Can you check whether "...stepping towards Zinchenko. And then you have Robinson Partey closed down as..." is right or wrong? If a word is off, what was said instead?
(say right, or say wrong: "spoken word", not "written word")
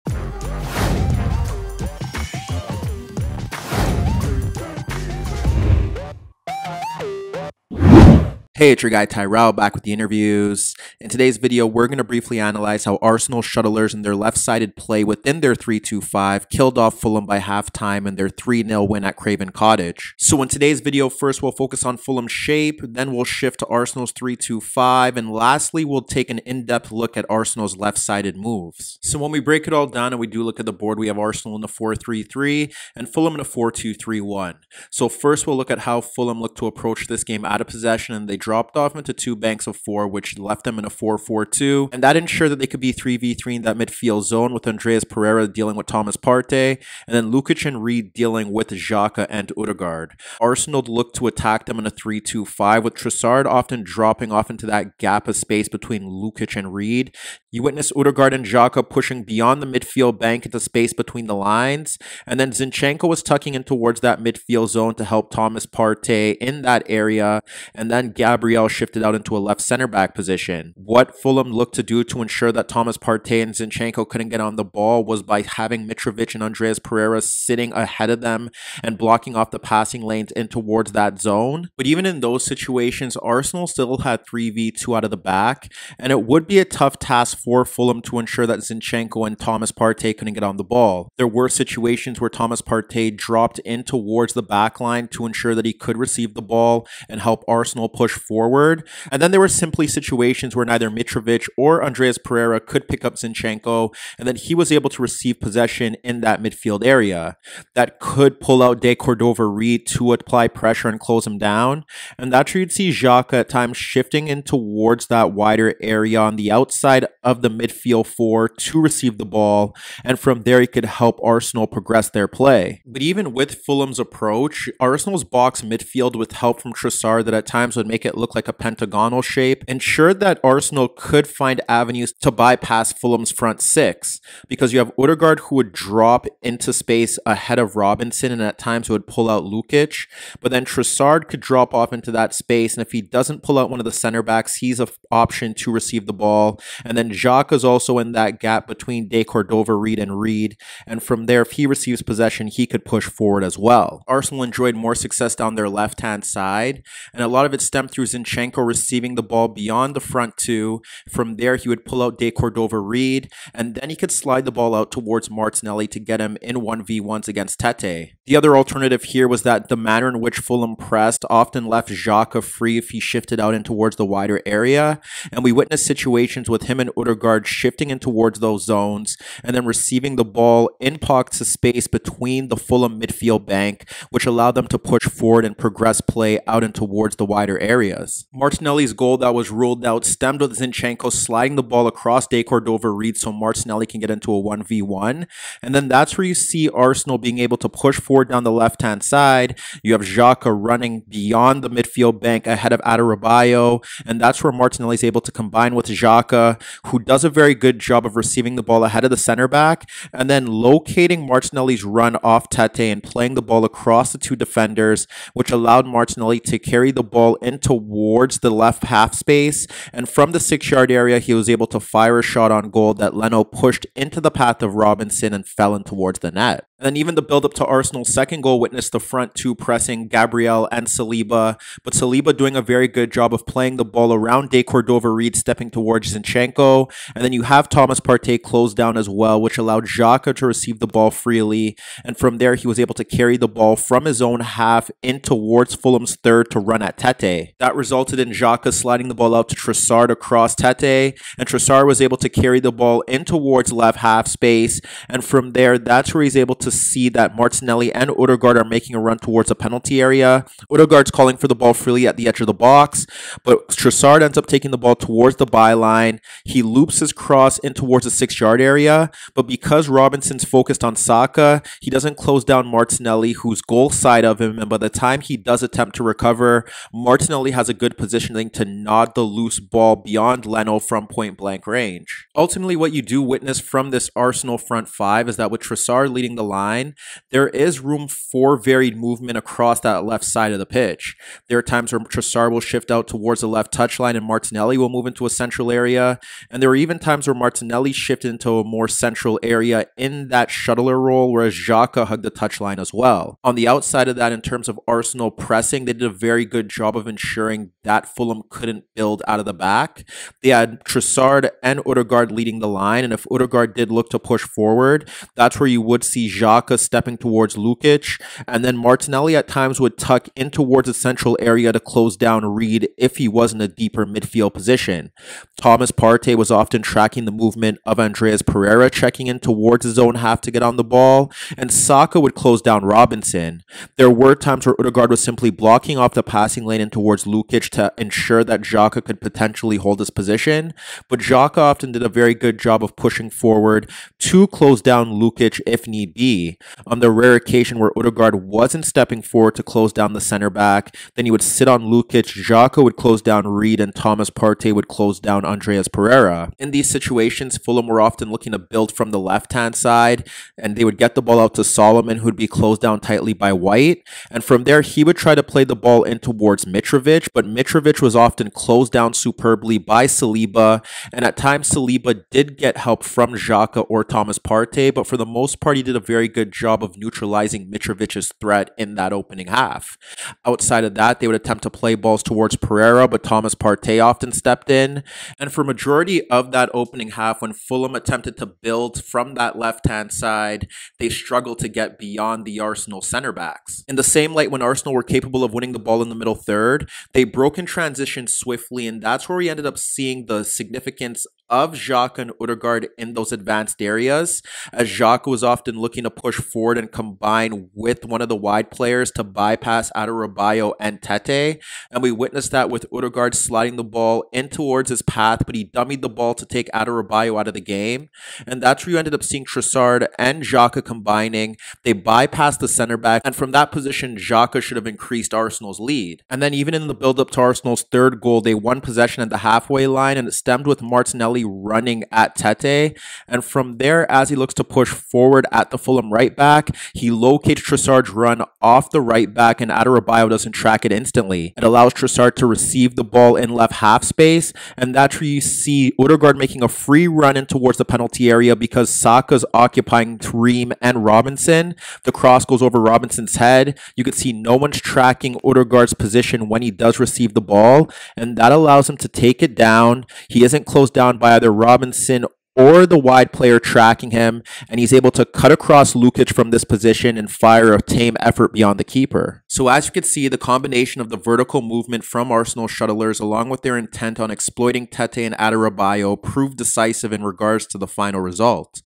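wrong: "Thomas", not "Robinson".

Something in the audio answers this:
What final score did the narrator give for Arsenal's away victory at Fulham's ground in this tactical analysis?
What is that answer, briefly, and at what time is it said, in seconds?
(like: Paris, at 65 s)
3-0, at 18 s.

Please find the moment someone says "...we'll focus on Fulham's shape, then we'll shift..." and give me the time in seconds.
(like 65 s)
21 s.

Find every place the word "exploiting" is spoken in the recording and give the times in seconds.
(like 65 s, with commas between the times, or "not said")
474 s.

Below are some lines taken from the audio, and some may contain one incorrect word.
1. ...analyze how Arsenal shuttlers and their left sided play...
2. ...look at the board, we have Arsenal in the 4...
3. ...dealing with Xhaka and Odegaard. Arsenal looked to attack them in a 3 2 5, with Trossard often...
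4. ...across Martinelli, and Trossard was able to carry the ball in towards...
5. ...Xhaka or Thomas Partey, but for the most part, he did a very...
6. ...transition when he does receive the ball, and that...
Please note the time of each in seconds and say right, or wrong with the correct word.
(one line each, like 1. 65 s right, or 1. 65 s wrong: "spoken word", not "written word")
1. 12 s right
2. 30 s right
3. 48 s right
4. 250 s wrong: "Tete", not "Martinelli"
5. 373 s right
6. 455 s wrong: "position", not "transition".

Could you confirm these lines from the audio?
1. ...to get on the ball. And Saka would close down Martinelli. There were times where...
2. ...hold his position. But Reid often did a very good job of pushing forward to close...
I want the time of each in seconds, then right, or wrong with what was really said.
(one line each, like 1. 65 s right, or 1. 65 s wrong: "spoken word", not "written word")
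1. 330 s wrong: "Robinson", not "Martinelli"
2. 339 s wrong: "Xhaka", not "Reid".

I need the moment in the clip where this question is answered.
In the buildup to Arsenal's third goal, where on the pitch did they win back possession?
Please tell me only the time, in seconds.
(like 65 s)
429 s.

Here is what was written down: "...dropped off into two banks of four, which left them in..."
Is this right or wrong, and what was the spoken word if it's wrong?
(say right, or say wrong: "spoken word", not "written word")
right.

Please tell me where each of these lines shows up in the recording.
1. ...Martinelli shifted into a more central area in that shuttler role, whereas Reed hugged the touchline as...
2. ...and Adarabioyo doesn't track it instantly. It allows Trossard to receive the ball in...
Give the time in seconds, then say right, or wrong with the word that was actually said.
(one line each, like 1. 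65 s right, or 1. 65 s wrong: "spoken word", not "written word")
1. 297 s wrong: "Xhaka", not "Reed"
2. 439 s right.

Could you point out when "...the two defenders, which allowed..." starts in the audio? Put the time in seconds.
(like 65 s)
214 s.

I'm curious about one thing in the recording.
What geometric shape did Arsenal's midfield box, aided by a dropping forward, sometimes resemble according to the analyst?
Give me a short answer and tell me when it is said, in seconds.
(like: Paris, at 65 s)
Pentagonal, at 128 s.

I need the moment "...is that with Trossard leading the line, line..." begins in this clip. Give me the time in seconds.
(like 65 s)
285 s.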